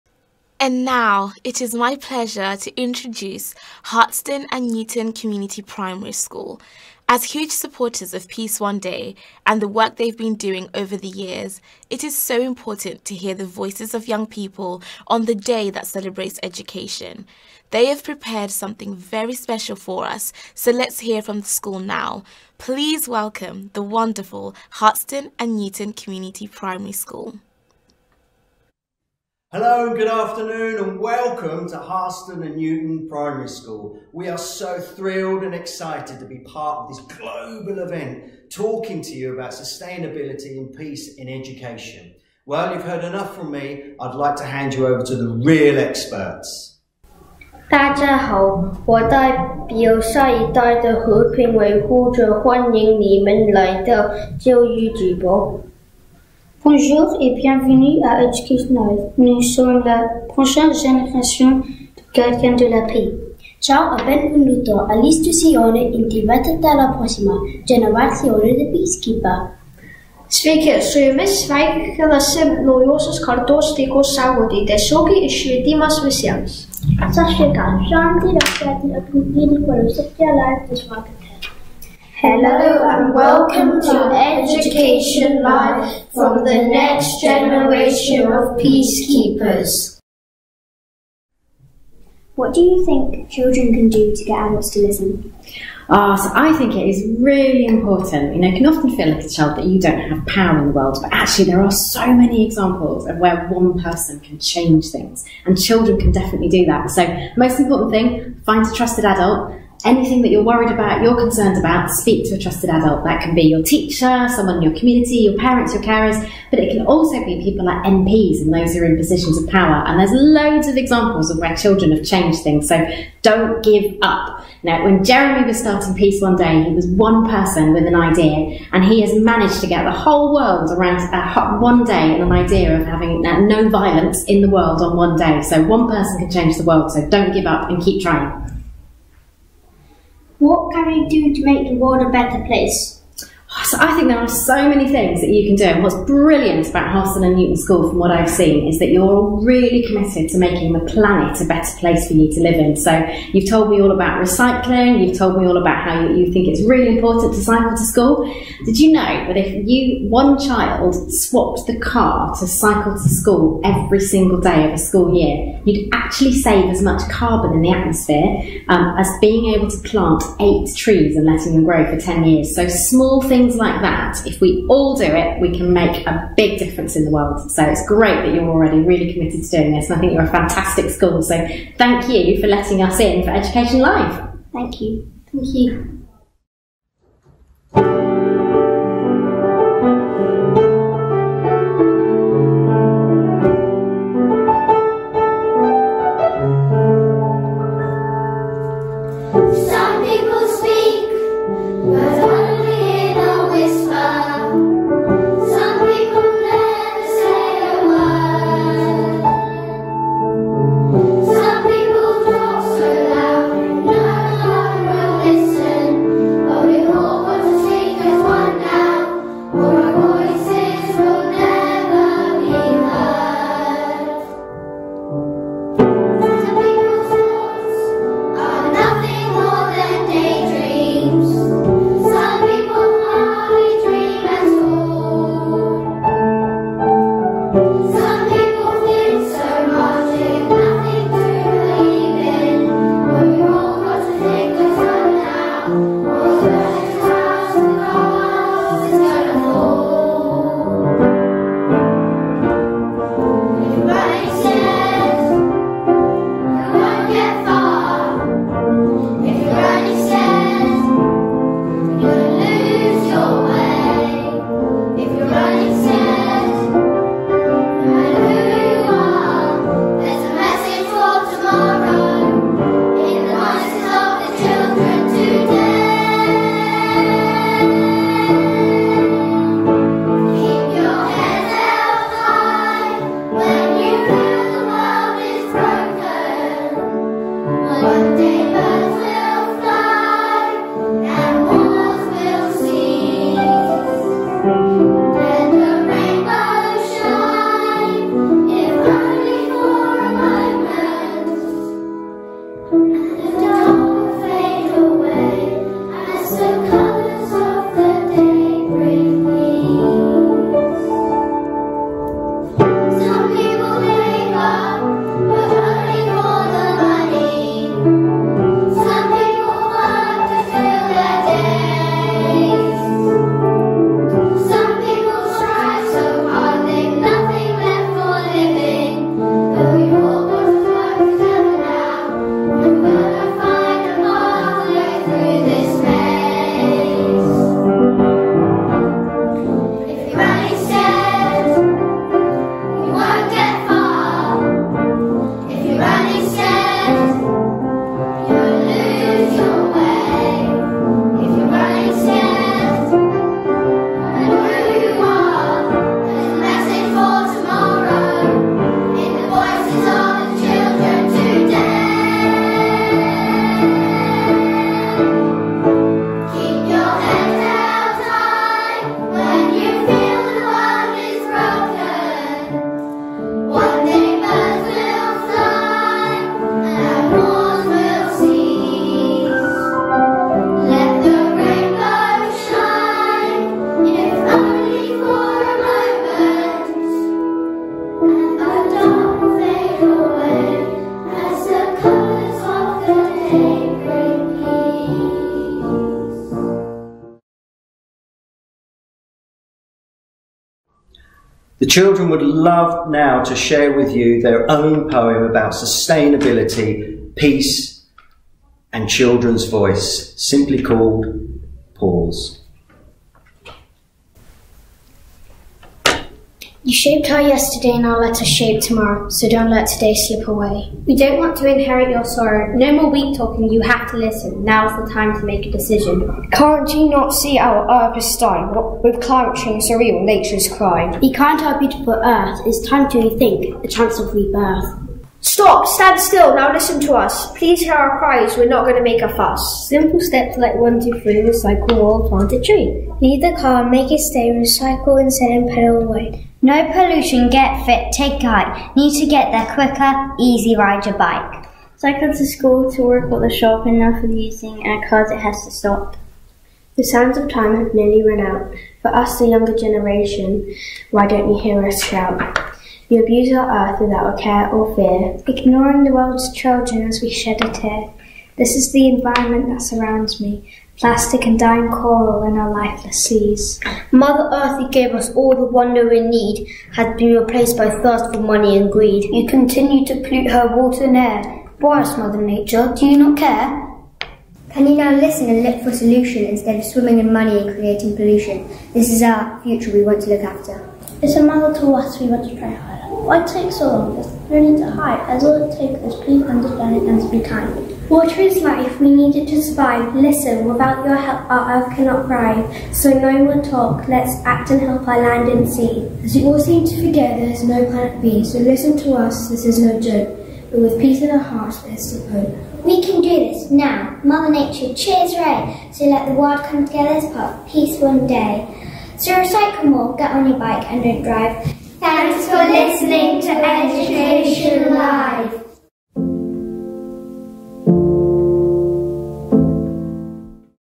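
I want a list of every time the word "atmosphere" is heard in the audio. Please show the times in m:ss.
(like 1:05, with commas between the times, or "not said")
2:47.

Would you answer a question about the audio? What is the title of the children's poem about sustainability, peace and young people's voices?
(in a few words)
Pause.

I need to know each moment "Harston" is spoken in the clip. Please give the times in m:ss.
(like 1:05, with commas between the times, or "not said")
0:03, 0:24, 0:31, 2:26.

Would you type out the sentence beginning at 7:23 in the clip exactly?
Leave the car, make it stay, recycle and send and pedal away.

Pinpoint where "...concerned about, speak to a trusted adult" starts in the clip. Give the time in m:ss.
1:51.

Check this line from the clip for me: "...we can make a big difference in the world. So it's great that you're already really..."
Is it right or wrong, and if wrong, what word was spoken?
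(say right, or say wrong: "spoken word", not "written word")
right.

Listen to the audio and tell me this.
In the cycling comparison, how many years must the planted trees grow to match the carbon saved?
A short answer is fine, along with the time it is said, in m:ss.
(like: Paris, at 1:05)
10, at 2:52.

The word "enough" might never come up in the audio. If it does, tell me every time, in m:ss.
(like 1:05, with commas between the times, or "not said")
0:43, 7:33.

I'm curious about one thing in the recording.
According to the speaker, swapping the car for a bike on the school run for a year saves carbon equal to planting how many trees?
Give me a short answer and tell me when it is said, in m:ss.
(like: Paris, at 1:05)
8, at 2:50.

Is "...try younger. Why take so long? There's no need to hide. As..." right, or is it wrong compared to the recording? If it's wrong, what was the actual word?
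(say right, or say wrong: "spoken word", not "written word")
wrong: "harder", not "younger".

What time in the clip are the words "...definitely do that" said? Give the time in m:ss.
1:46.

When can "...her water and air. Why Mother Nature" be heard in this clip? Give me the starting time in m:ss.
8:00.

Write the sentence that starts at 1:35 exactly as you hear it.
Ah, so I think it is really important.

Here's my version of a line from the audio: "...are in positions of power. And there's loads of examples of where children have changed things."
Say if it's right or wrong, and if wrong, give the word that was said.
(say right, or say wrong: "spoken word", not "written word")
right.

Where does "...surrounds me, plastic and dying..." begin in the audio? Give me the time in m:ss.
7:49.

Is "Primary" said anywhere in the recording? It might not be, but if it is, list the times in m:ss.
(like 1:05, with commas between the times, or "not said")
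0:05, 0:26, 0:33.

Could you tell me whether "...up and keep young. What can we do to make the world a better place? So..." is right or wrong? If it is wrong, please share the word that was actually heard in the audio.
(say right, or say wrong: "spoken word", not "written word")
wrong: "trying", not "young".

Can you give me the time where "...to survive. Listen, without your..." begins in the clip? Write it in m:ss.
8:19.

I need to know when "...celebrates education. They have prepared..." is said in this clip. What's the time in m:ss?
0:15.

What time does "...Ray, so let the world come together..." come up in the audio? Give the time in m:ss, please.
8:35.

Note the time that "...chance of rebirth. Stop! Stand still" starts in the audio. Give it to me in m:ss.
7:13.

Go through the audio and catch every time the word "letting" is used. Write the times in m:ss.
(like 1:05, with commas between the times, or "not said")
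2:51, 3:02.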